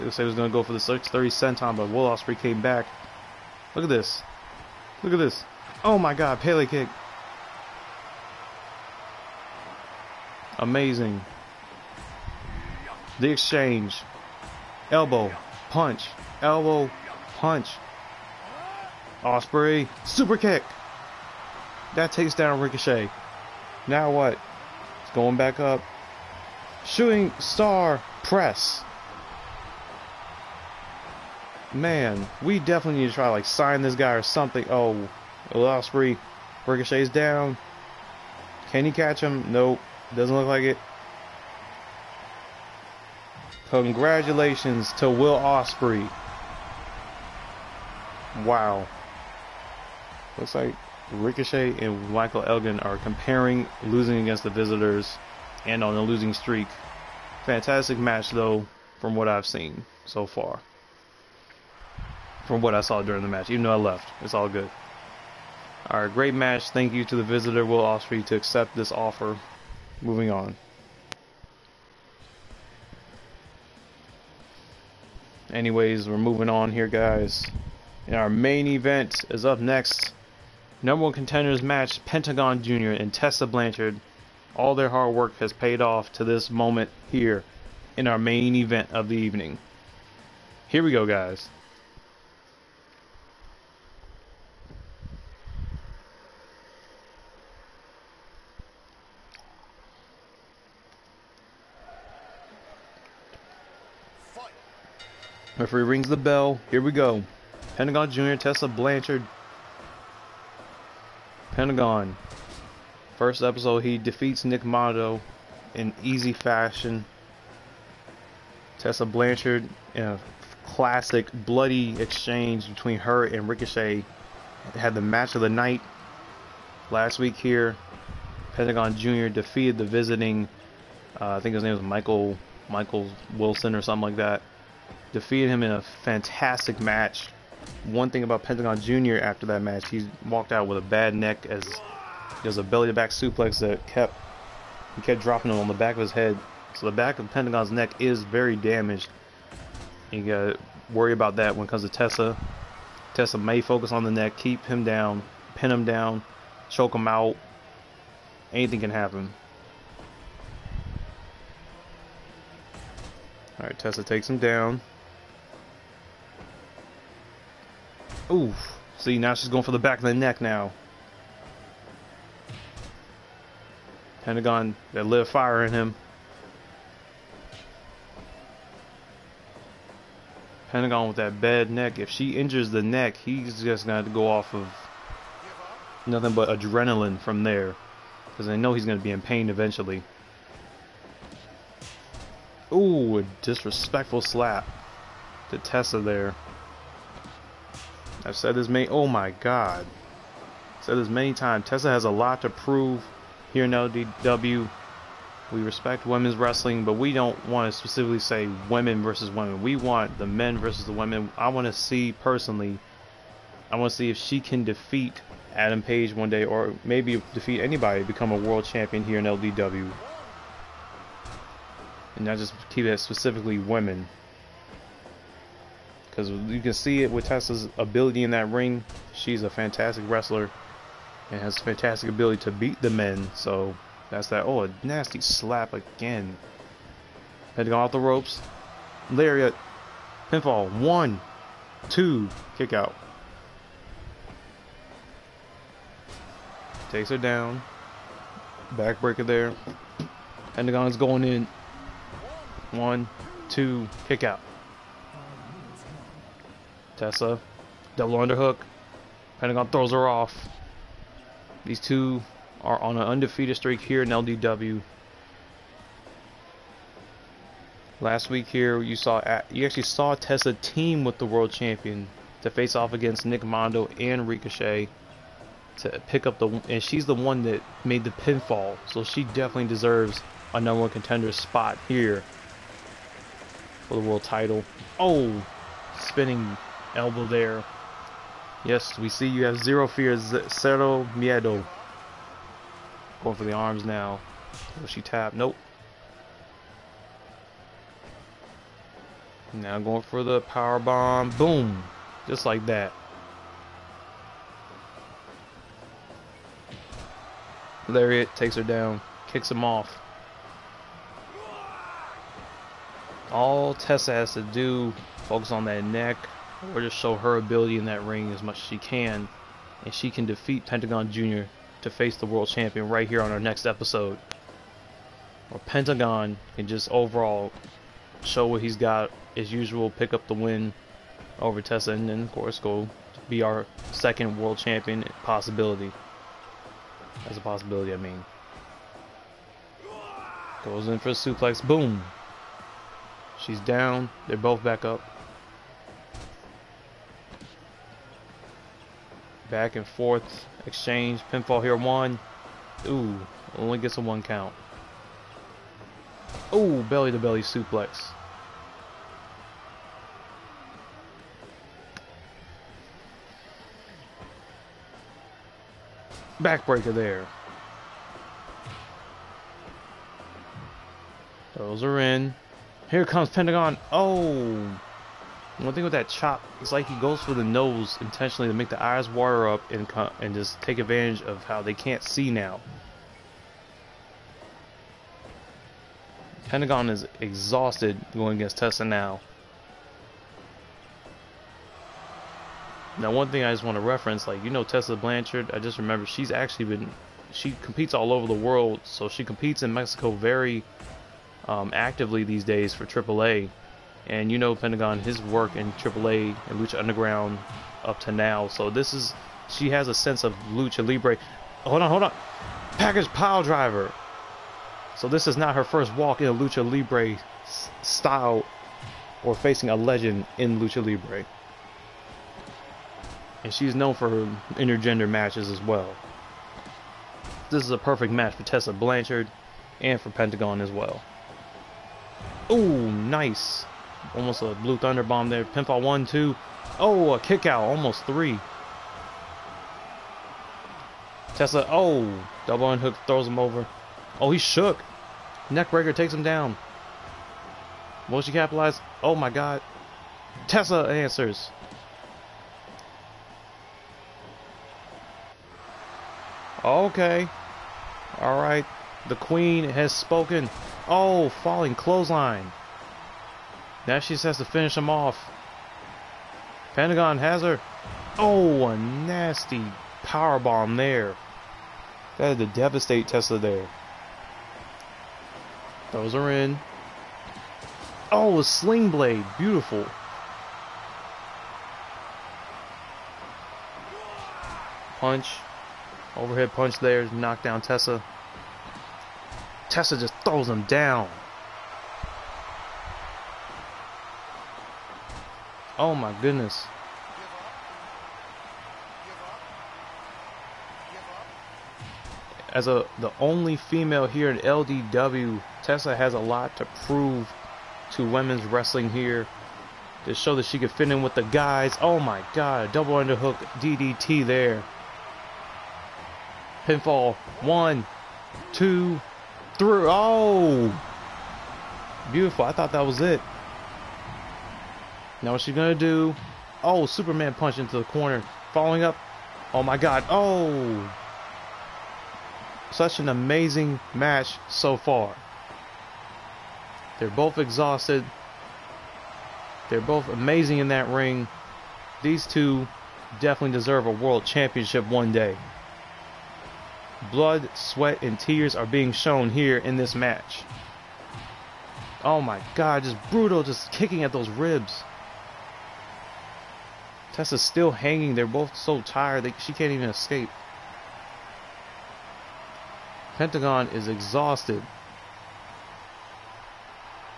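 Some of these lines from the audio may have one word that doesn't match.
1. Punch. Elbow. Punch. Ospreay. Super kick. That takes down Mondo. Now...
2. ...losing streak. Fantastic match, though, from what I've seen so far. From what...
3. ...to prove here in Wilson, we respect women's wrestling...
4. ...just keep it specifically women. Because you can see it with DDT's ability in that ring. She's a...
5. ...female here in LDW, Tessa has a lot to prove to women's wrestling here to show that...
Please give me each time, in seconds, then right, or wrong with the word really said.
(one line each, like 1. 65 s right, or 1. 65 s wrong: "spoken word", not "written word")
1. 15 s wrong: "Ricochet", not "Mondo"
2. 56 s right
3. 202 s wrong: "LDW", not "Wilson"
4. 222 s wrong: "Tessa", not "DDT"
5. 503 s right.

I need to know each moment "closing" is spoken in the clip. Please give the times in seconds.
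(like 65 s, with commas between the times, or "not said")
not said.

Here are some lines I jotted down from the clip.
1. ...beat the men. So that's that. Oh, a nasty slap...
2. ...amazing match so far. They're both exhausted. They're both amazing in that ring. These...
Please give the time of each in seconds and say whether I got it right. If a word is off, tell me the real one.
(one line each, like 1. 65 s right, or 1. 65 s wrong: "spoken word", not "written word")
1. 232 s right
2. 533 s right.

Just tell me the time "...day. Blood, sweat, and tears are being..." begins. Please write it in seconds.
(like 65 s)
545 s.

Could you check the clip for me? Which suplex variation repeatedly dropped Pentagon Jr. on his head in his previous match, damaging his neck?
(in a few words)
Belly to back suplex.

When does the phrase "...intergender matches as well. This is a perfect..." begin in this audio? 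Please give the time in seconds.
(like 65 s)
424 s.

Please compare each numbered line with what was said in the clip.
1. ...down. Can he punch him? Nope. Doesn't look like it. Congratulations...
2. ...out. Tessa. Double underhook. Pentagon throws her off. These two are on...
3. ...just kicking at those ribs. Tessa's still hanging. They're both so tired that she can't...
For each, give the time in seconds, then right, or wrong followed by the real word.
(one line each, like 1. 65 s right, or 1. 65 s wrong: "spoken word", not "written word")
1. 37 s wrong: "catch", not "punch"
2. 254 s right
3. 553 s right.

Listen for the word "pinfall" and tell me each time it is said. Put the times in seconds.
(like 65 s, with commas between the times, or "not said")
240 s, 278 s, 351 s, 435 s, 516 s.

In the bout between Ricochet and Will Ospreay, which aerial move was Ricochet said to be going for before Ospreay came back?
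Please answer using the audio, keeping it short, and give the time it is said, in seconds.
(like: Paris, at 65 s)
630 senton, at 0 s.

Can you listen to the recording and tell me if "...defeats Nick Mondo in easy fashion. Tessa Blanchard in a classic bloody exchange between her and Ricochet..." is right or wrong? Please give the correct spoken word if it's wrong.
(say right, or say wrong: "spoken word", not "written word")
right.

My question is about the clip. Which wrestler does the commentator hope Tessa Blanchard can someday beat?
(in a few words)
Adam Page.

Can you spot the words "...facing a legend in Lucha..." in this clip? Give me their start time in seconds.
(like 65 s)
419 s.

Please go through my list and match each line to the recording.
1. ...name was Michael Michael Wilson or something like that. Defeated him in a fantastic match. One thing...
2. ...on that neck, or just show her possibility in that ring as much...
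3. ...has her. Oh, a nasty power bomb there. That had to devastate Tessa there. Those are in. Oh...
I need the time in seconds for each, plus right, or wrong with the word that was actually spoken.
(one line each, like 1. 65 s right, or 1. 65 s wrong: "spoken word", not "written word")
1. 131 s right
2. 315 s wrong: "ability", not "possibility"
3. 467 s right.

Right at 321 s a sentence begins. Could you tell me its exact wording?
to face the world champion right here on our next episode.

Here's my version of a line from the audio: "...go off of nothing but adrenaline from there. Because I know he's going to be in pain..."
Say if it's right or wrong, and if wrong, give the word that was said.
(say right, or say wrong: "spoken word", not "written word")
right.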